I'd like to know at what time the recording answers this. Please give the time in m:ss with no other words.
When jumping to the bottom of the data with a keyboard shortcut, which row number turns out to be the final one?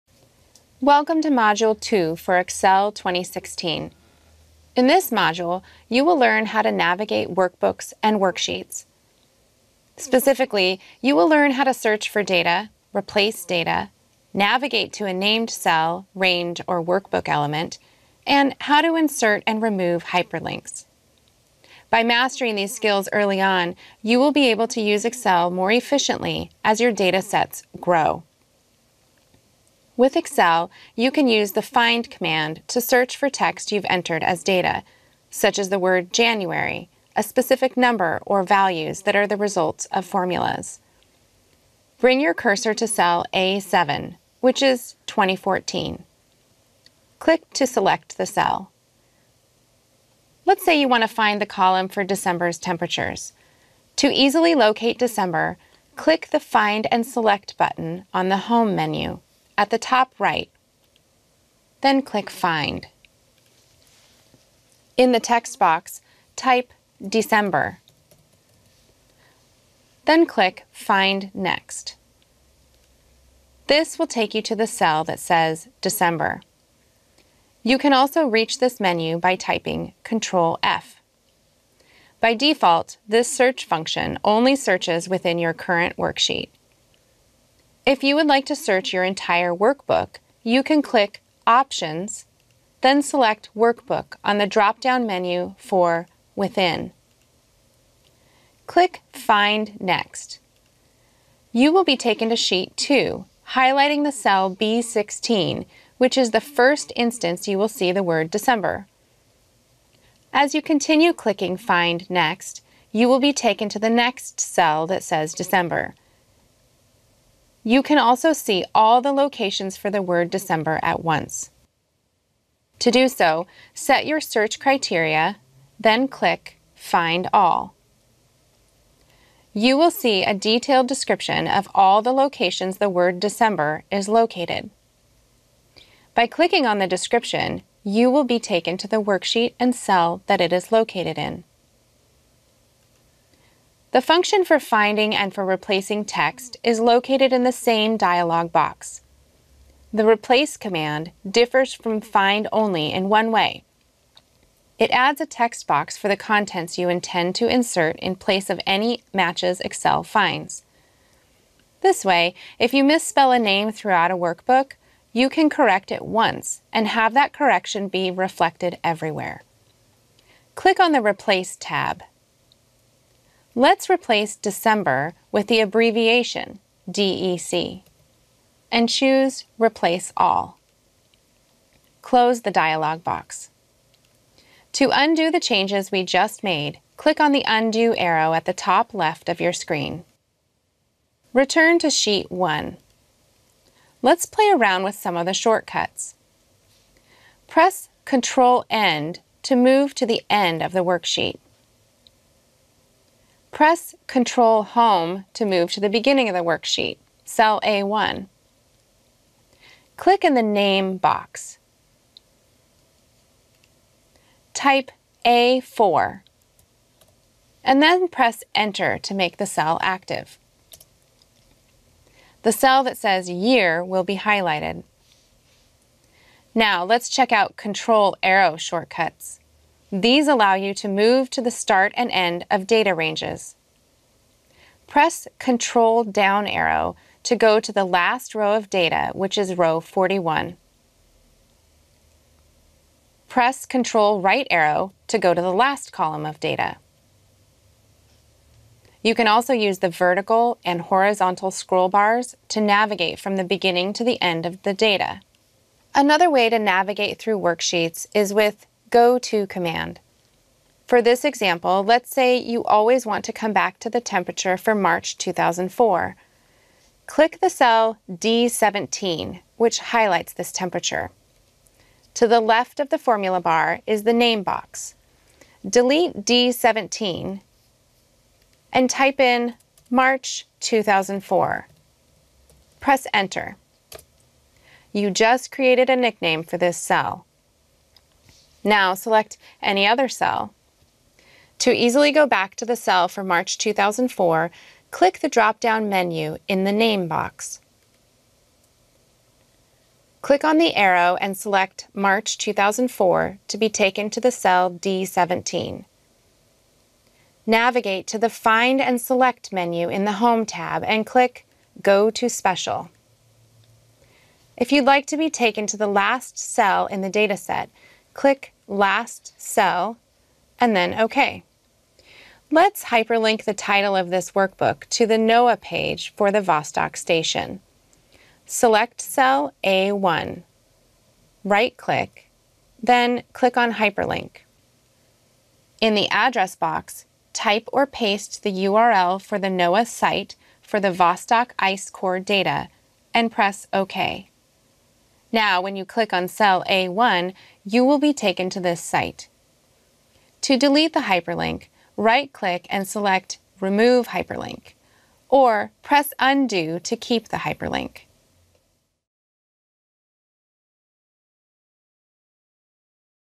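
3:59.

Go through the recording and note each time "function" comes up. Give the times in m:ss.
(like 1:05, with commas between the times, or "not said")
1:23, 2:24.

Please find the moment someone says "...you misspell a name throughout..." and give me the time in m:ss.
2:42.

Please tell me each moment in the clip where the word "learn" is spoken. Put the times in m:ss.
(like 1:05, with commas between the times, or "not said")
0:06, 0:11.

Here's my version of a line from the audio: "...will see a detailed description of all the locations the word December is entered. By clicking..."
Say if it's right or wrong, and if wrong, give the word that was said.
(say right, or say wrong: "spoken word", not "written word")
wrong: "located", not "entered".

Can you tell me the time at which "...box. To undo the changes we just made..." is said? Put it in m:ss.
3:03.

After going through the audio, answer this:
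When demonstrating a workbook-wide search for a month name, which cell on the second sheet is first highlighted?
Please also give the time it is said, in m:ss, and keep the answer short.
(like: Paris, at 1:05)
B16, at 1:44.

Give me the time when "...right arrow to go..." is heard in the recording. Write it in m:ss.
4:04.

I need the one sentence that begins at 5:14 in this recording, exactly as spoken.
If you'd like to be taken to the last cell in the dataset, click last cell, and then OK.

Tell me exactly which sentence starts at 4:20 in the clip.
For this example, let's say you always want to come back to the temperature for March 2004.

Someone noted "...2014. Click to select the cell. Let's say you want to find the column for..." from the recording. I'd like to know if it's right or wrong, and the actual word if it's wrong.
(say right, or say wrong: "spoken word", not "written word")
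right.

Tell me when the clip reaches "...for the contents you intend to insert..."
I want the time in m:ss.
2:35.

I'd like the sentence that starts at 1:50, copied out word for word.
As you continue clicking Find Next, you will be taken to the next cell that says December.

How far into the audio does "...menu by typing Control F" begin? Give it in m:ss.
1:18.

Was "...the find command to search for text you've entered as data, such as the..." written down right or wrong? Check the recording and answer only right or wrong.
right.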